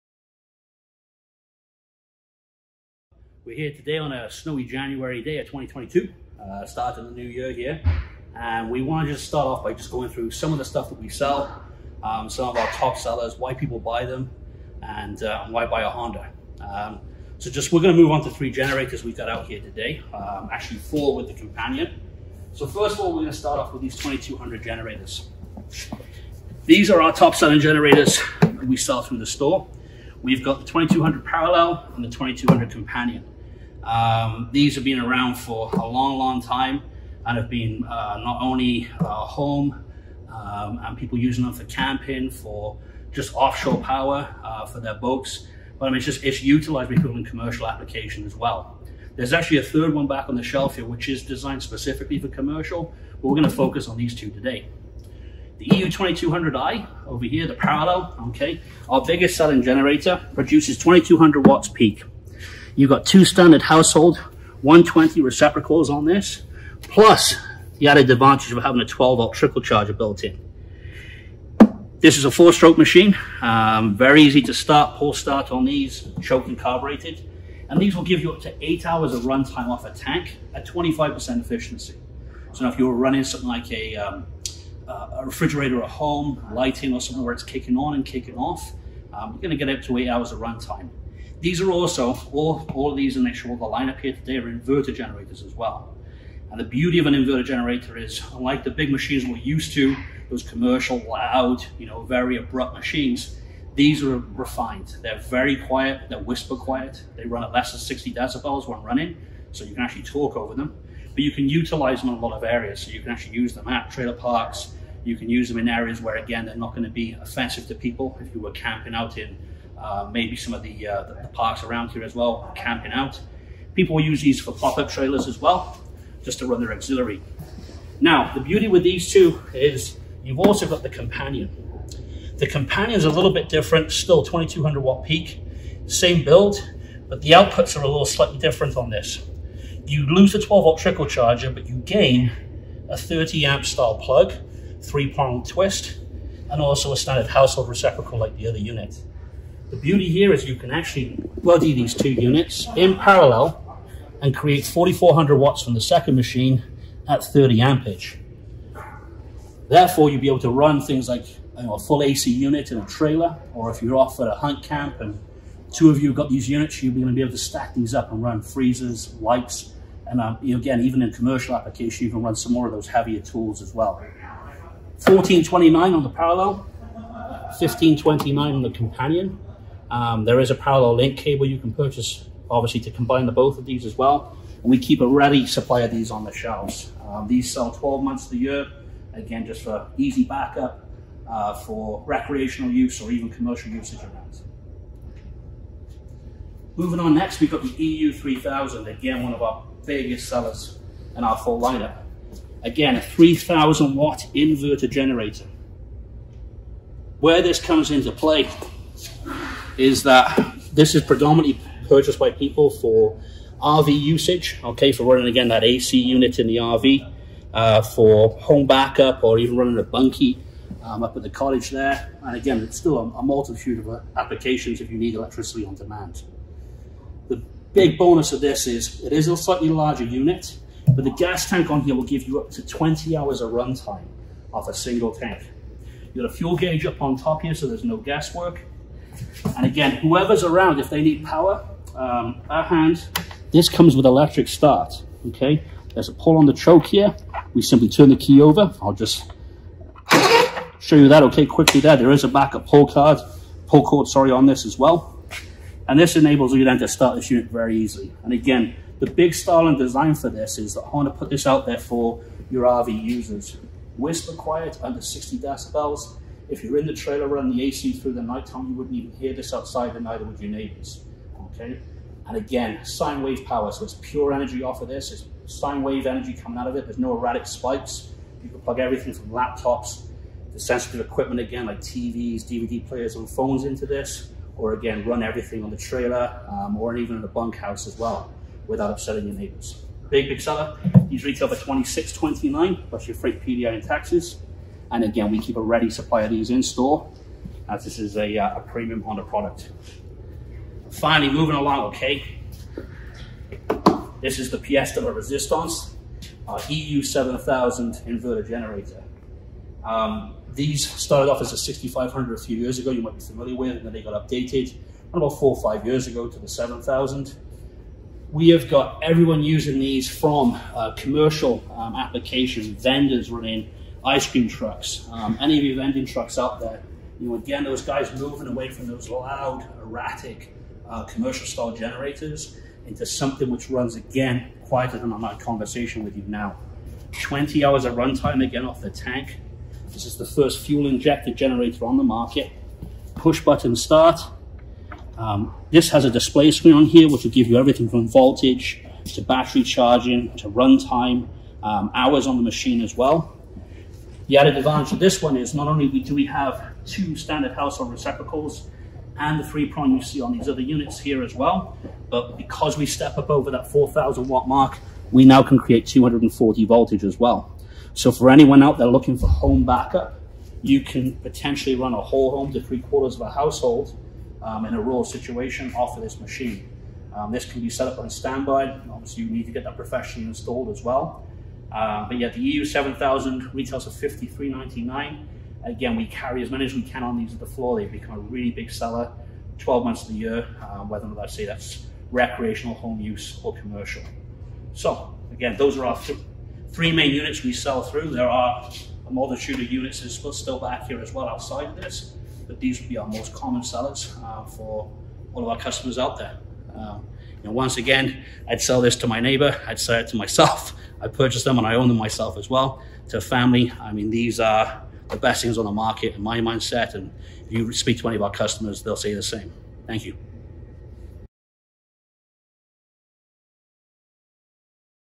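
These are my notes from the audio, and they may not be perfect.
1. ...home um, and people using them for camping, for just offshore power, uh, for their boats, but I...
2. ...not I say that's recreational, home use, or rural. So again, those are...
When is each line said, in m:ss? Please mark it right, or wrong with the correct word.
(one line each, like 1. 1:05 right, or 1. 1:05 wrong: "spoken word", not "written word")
1. 0:39 right
2. 6:31 wrong: "commercial", not "rural".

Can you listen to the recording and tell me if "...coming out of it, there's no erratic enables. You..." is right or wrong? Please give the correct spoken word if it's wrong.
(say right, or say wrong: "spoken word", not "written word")
wrong: "spikes", not "enables".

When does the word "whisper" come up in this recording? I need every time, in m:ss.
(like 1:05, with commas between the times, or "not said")
1:46, 4:23.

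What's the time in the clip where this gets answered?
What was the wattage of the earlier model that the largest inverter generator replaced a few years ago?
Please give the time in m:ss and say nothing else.
5:11.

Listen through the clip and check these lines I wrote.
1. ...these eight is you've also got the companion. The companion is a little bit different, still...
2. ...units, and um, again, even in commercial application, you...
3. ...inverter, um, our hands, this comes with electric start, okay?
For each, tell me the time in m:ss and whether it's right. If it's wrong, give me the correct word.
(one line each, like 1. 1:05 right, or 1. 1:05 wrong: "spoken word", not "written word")
1. 2:08 wrong: "two", not "eight"
2. 2:49 wrong: "lights", not "units"
3. 4:01 wrong: "power", not "inverter".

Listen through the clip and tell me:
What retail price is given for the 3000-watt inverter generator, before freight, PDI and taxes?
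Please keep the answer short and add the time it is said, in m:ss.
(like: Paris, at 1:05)
26.29, at 4:51.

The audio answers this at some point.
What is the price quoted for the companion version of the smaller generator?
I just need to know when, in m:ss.
2:57.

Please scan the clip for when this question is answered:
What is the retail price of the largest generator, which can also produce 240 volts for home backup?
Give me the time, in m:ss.
6:24.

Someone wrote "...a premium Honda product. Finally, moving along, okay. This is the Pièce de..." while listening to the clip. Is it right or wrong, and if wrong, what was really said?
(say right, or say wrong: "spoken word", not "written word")
right.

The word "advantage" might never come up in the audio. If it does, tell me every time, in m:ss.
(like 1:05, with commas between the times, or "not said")
1:08, 5:54.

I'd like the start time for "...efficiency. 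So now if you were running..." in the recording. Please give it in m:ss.
1:21.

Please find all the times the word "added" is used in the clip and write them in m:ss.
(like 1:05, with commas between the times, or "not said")
1:07, 5:54.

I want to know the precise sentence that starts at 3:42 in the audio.
And again, it's still a, a multitude of uh, applications if you need electricity on demand.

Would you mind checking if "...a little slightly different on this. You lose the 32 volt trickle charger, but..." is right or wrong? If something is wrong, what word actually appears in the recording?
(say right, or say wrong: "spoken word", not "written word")
wrong: "12", not "32".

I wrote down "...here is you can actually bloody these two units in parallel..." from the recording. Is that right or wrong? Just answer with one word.
right.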